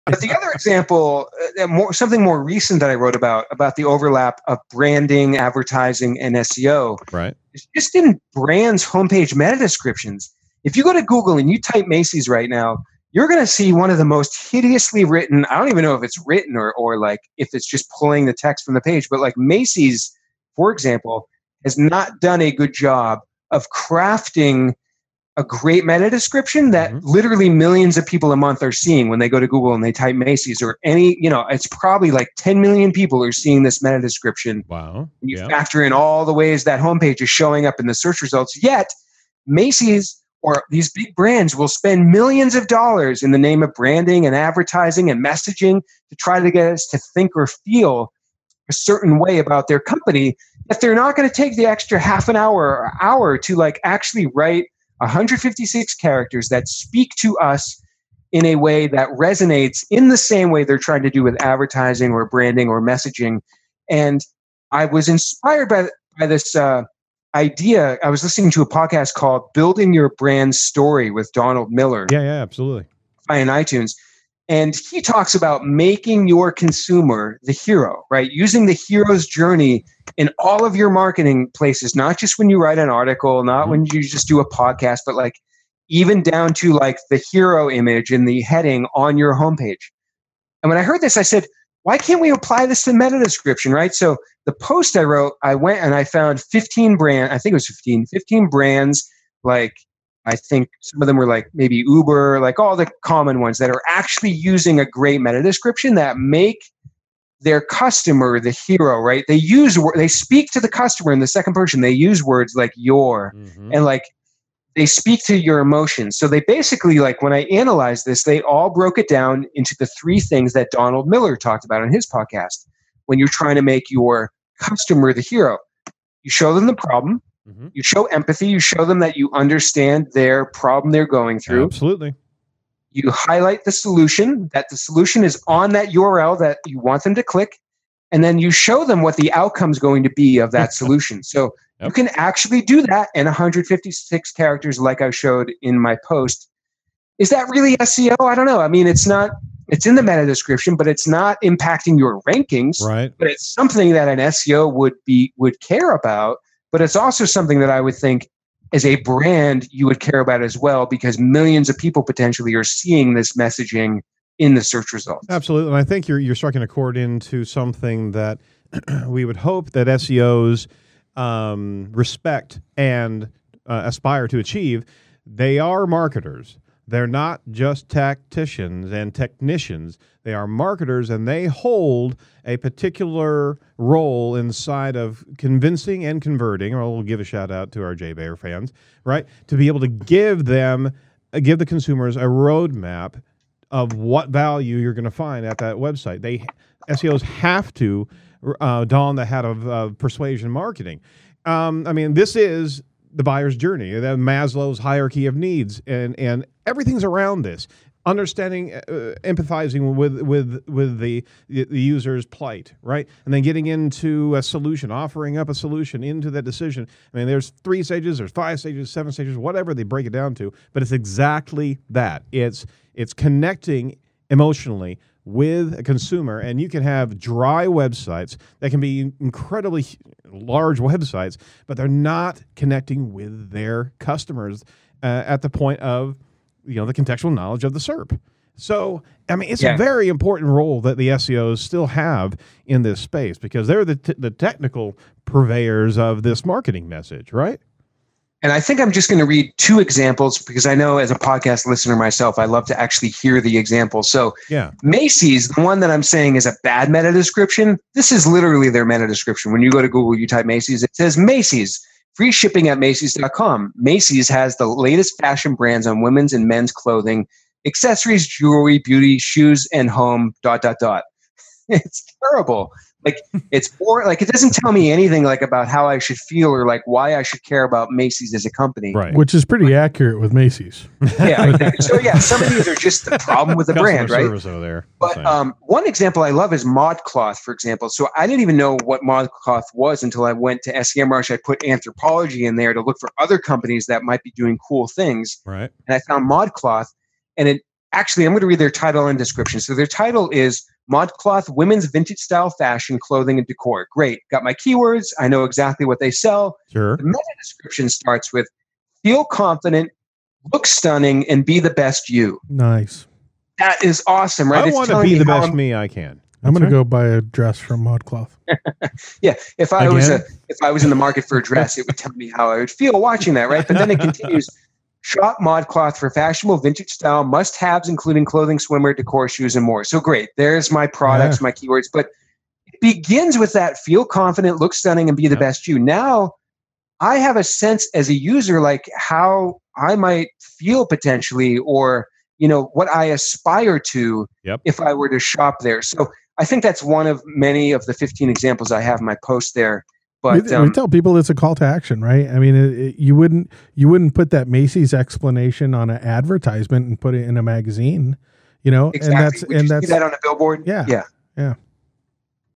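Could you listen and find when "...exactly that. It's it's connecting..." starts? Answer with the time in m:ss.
3:40.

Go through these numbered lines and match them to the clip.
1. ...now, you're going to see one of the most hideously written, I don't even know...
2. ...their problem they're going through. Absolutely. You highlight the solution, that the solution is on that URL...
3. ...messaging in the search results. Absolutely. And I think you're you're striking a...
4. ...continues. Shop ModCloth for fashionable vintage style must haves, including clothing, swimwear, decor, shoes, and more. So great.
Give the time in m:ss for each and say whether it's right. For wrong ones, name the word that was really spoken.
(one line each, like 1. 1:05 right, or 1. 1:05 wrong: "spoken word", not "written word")
1. 0:12 right
2. 2:10 right
3. 2:43 right
4. 5:23 right.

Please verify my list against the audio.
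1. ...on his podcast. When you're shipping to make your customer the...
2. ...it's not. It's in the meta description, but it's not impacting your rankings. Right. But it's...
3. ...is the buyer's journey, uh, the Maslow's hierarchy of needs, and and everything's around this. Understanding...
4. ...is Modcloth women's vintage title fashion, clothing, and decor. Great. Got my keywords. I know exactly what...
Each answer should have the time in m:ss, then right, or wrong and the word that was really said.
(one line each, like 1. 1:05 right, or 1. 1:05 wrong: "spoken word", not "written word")
1. 2:01 wrong: "trying", not "shipping"
2. 2:28 right
3. 3:22 right
4. 5:00 wrong: "style", not "title".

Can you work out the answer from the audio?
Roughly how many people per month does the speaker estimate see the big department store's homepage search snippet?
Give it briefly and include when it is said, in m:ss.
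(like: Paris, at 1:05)
10 million, at 0:32.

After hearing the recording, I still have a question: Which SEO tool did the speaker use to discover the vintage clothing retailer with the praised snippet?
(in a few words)
SEMrush.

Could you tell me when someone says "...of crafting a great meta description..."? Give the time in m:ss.
0:23.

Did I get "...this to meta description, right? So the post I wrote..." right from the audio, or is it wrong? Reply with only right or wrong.
right.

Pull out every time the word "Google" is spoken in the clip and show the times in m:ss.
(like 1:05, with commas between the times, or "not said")
0:11, 0:29, 4:19.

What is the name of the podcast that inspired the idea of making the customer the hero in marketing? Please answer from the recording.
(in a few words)
Building Your Brand Story.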